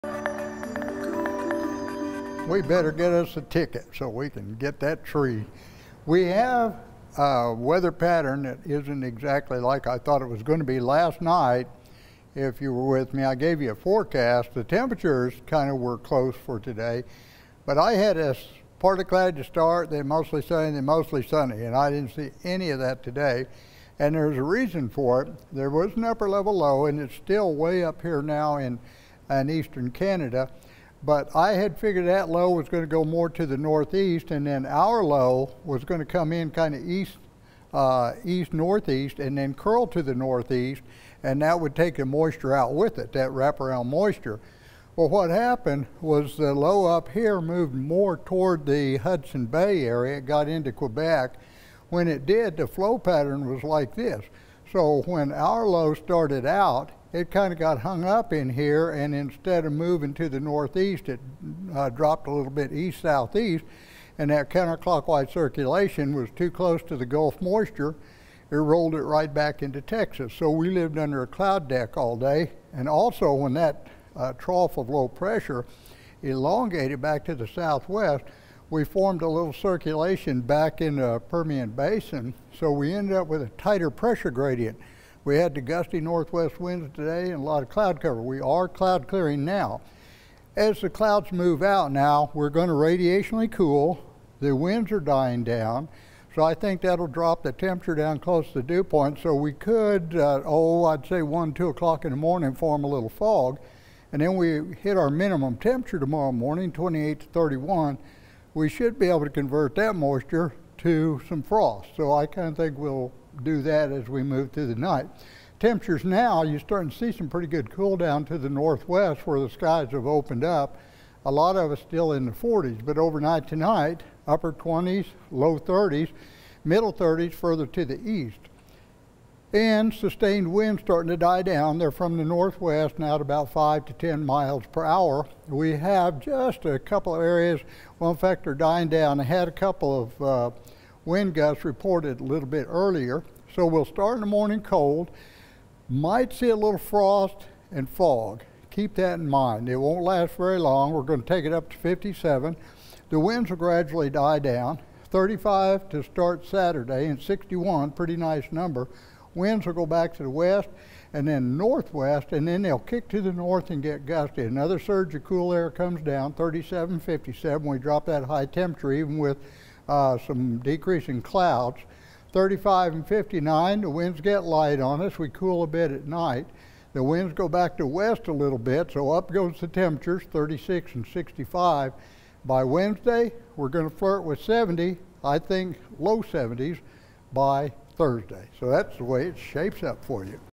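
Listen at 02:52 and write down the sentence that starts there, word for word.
35 and 59, the winds get light on us.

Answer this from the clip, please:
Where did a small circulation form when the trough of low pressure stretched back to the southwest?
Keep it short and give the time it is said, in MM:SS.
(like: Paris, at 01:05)
Permian Basin, at 01:21.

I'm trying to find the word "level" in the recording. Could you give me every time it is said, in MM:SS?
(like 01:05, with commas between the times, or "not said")
00:26.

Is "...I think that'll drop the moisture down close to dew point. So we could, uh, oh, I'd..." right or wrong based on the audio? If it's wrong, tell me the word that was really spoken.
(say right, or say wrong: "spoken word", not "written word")
wrong: "temperature", not "moisture".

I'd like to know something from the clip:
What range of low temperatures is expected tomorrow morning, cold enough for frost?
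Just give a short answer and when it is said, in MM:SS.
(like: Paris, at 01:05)
28 to 31, at 01:46.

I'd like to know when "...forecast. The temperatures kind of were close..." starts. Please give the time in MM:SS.
00:13.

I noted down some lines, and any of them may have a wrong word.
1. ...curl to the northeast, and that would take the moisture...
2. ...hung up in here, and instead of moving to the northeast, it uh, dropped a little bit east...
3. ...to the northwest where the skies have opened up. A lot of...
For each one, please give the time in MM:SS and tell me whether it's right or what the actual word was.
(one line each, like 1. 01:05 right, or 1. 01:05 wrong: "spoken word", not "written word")
1. 00:39 right
2. 00:57 right
3. 01:58 right.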